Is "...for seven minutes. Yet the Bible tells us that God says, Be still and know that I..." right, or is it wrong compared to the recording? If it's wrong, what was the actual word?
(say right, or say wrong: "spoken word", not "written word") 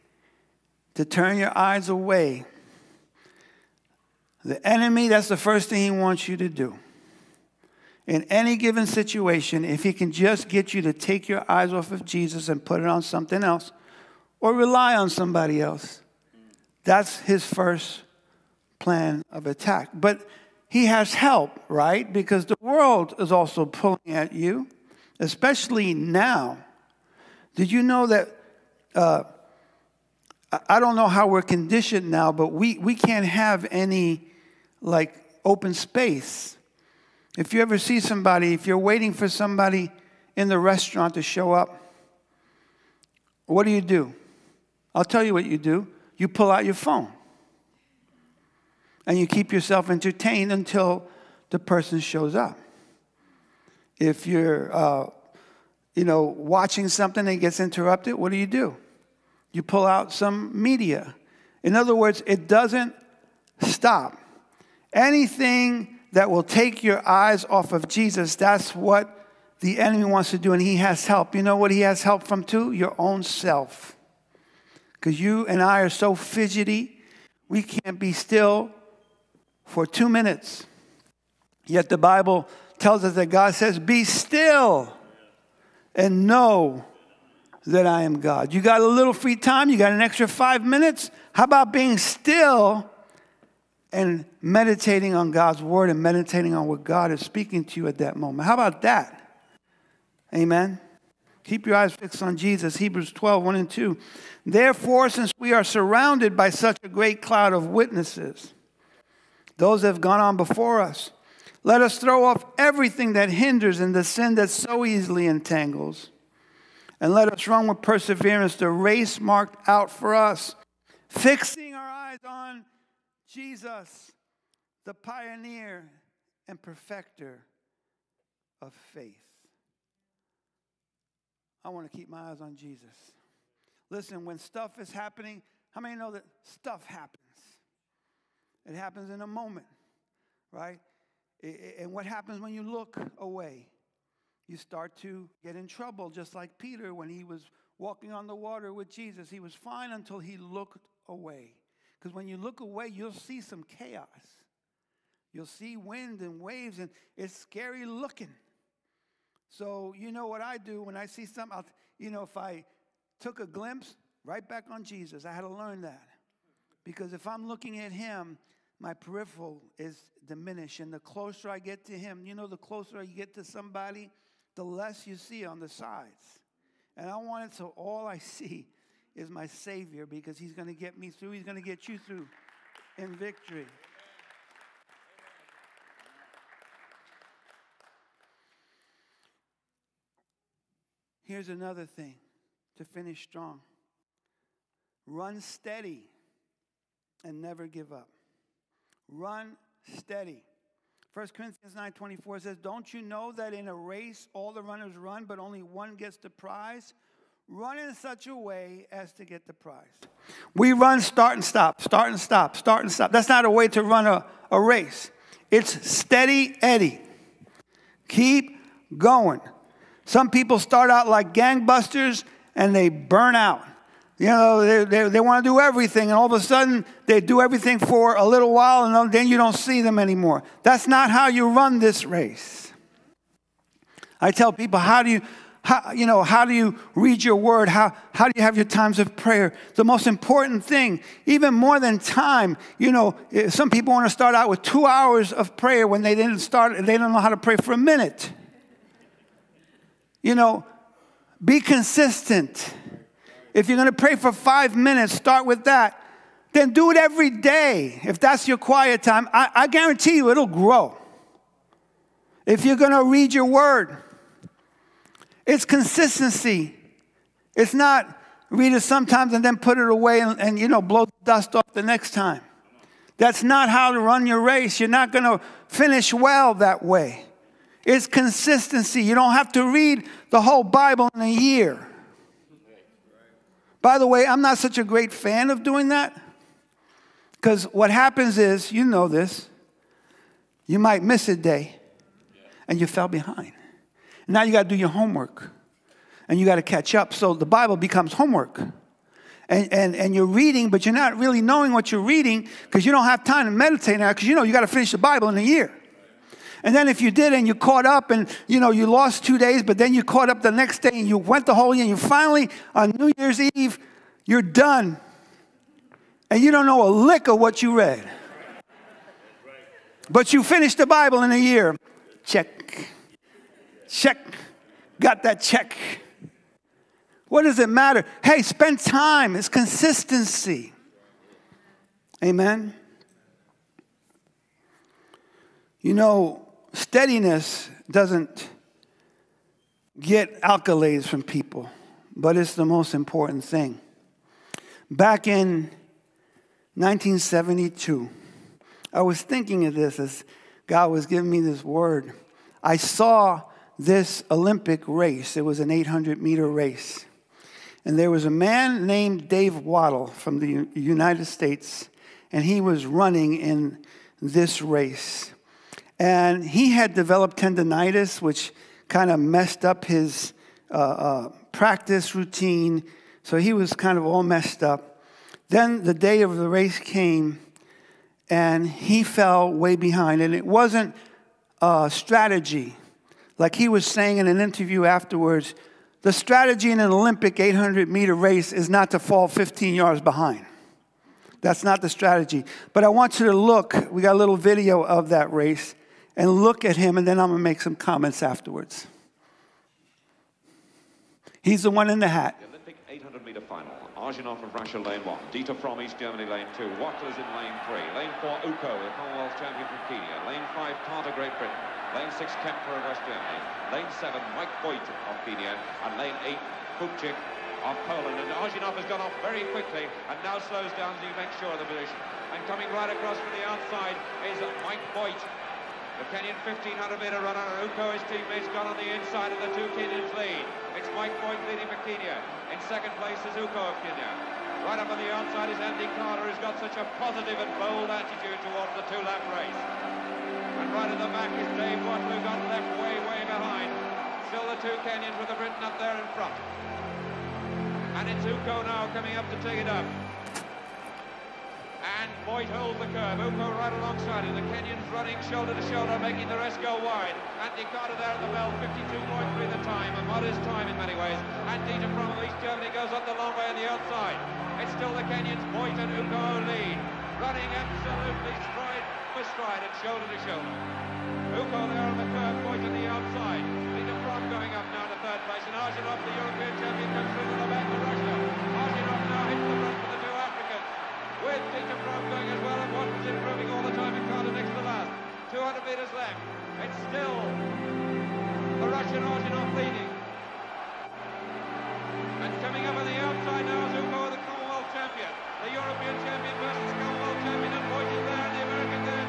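wrong: "two", not "seven".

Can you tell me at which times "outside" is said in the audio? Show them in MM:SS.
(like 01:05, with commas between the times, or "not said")
07:03, 07:15, 07:43.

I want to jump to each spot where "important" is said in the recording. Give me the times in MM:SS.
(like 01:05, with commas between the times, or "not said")
04:00, 05:42.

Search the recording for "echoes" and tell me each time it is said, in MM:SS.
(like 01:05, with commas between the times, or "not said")
not said.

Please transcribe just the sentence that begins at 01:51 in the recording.
Let us throw off everything that hinders and the sin that so easily entangles.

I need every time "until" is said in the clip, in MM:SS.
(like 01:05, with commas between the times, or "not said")
00:50, 02:29.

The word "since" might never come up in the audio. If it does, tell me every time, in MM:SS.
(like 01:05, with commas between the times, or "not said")
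01:45.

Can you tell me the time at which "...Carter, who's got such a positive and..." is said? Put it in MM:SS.
07:15.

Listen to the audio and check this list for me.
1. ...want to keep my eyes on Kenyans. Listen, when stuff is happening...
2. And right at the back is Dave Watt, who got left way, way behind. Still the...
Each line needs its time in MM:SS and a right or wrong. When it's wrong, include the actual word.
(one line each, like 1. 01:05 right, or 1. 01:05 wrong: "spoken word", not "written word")
1. 02:11 wrong: "Jesus", not "Kenyans"
2. 07:20 right.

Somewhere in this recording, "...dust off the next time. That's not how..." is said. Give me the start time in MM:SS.
04:31.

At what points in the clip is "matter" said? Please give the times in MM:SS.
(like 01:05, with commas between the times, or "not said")
05:27.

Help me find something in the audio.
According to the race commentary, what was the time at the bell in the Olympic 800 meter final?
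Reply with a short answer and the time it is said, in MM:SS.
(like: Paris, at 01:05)
52.3, at 07:38.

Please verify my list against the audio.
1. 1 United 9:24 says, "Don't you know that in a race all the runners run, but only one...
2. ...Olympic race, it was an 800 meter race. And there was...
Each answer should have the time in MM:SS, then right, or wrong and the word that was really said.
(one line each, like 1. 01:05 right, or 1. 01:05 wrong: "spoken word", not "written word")
1. 03:21 wrong: "Corinthians", not "United"
2. 05:54 right.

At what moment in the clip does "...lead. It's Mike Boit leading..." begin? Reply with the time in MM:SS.
07:10.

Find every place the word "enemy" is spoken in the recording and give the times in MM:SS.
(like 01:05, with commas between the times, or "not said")
00:04, 01:09.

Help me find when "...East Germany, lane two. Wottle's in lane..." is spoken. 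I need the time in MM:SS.
06:45.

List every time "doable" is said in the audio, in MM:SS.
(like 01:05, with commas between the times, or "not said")
not said.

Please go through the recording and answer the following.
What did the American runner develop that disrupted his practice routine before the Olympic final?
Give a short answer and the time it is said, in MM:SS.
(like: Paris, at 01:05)
Tendonitis, at 06:07.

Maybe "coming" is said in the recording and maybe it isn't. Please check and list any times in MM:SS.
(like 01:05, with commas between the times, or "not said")
07:02, 07:28.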